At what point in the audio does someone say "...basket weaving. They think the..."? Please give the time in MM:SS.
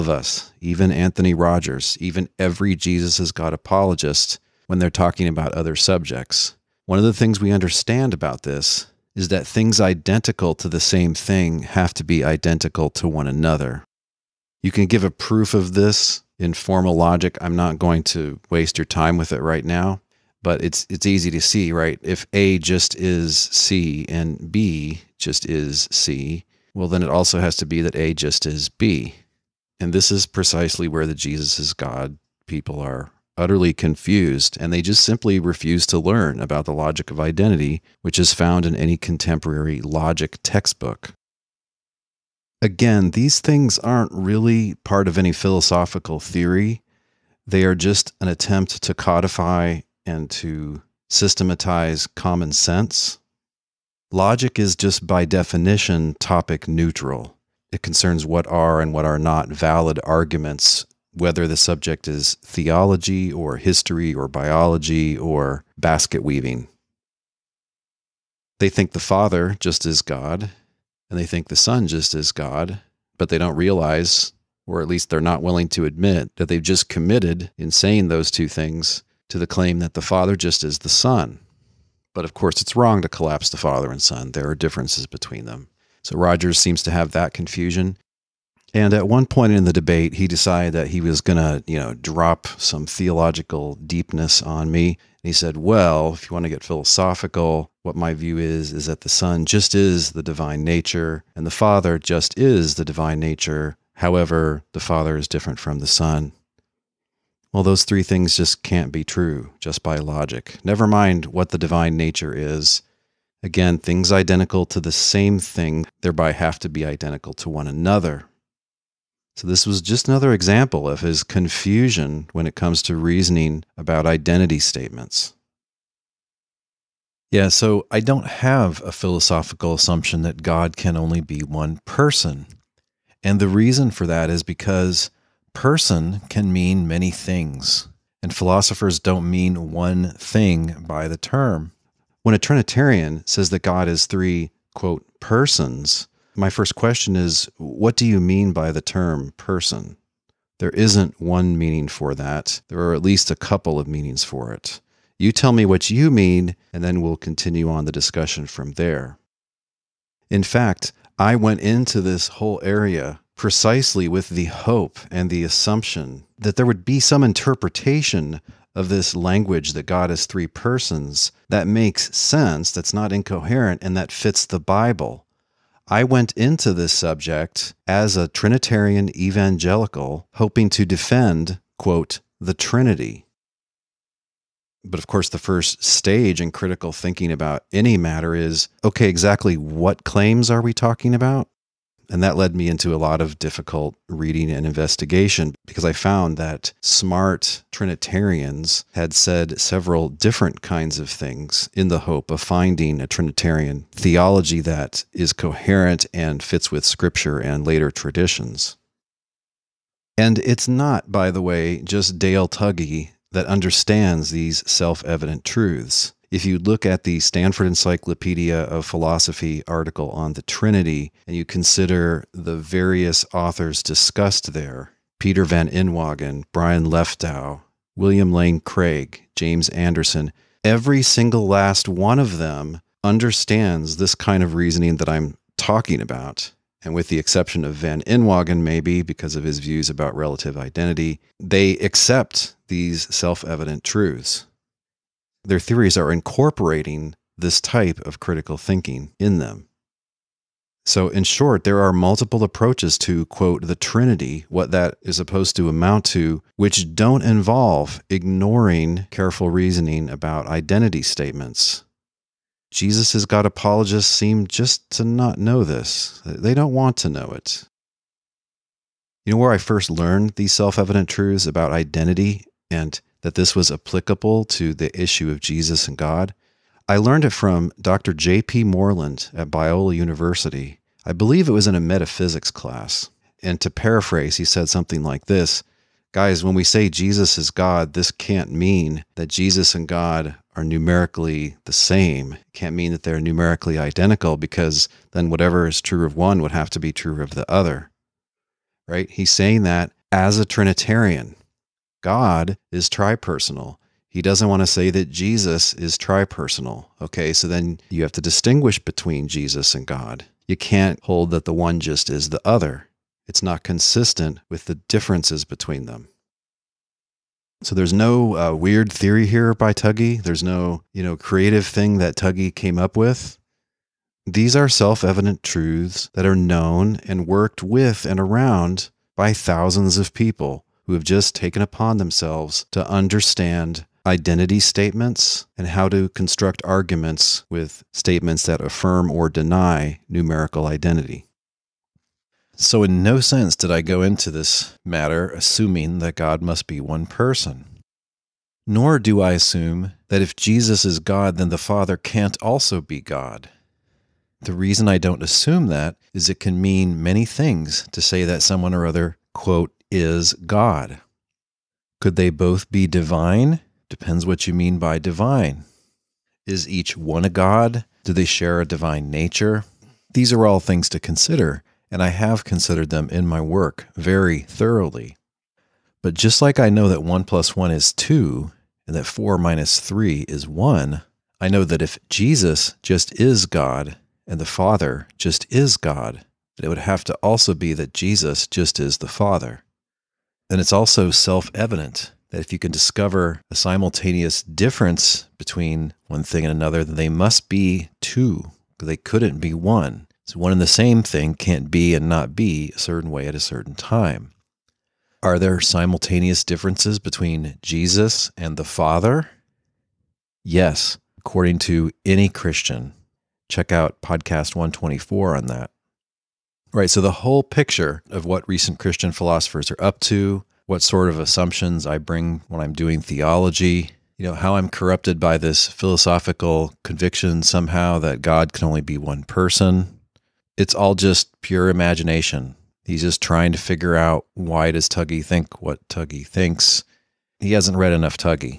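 01:05.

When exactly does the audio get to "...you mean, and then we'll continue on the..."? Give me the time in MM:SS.
02:35.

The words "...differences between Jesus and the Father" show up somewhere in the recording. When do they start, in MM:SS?
06:46.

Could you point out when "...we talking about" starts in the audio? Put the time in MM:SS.
03:10.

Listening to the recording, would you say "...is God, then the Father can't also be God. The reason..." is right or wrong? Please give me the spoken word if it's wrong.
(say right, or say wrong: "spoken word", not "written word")
right.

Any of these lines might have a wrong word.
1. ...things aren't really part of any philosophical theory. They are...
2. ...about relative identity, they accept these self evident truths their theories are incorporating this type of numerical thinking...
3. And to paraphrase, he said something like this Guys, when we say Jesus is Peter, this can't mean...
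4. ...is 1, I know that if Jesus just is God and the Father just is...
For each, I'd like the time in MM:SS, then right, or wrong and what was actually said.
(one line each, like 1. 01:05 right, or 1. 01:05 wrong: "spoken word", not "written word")
1. 00:43 right
2. 03:59 wrong: "critical", not "numerical"
3. 04:43 wrong: "God", not "Peter"
4. 06:20 right.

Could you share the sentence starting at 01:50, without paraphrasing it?
Never mind what the divine nature is.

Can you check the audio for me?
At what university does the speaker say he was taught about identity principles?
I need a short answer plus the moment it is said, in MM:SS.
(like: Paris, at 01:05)
Biola University, at 04:39.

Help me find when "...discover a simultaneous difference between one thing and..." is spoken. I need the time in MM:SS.
06:32.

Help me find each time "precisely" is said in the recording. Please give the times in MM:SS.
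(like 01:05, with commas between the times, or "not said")
00:30, 02:43.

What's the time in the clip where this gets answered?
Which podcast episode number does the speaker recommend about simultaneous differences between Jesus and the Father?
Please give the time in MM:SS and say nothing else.
06:54.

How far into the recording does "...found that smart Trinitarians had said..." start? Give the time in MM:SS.
03:15.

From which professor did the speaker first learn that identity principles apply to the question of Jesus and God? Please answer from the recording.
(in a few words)
J.P. Moreland.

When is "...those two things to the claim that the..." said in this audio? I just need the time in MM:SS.
01:18.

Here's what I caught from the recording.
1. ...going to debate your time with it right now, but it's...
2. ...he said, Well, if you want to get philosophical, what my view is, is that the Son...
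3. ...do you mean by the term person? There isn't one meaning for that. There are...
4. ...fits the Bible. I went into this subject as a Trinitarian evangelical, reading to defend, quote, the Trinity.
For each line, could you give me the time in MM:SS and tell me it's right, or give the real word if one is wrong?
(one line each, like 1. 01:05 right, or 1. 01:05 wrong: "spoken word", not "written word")
1. 00:17 wrong: "waste", not "debate"
2. 01:35 right
3. 02:27 right
4. 02:54 wrong: "hoping", not "reading".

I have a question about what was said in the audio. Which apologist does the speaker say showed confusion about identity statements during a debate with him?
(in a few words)
Anthony Rogers.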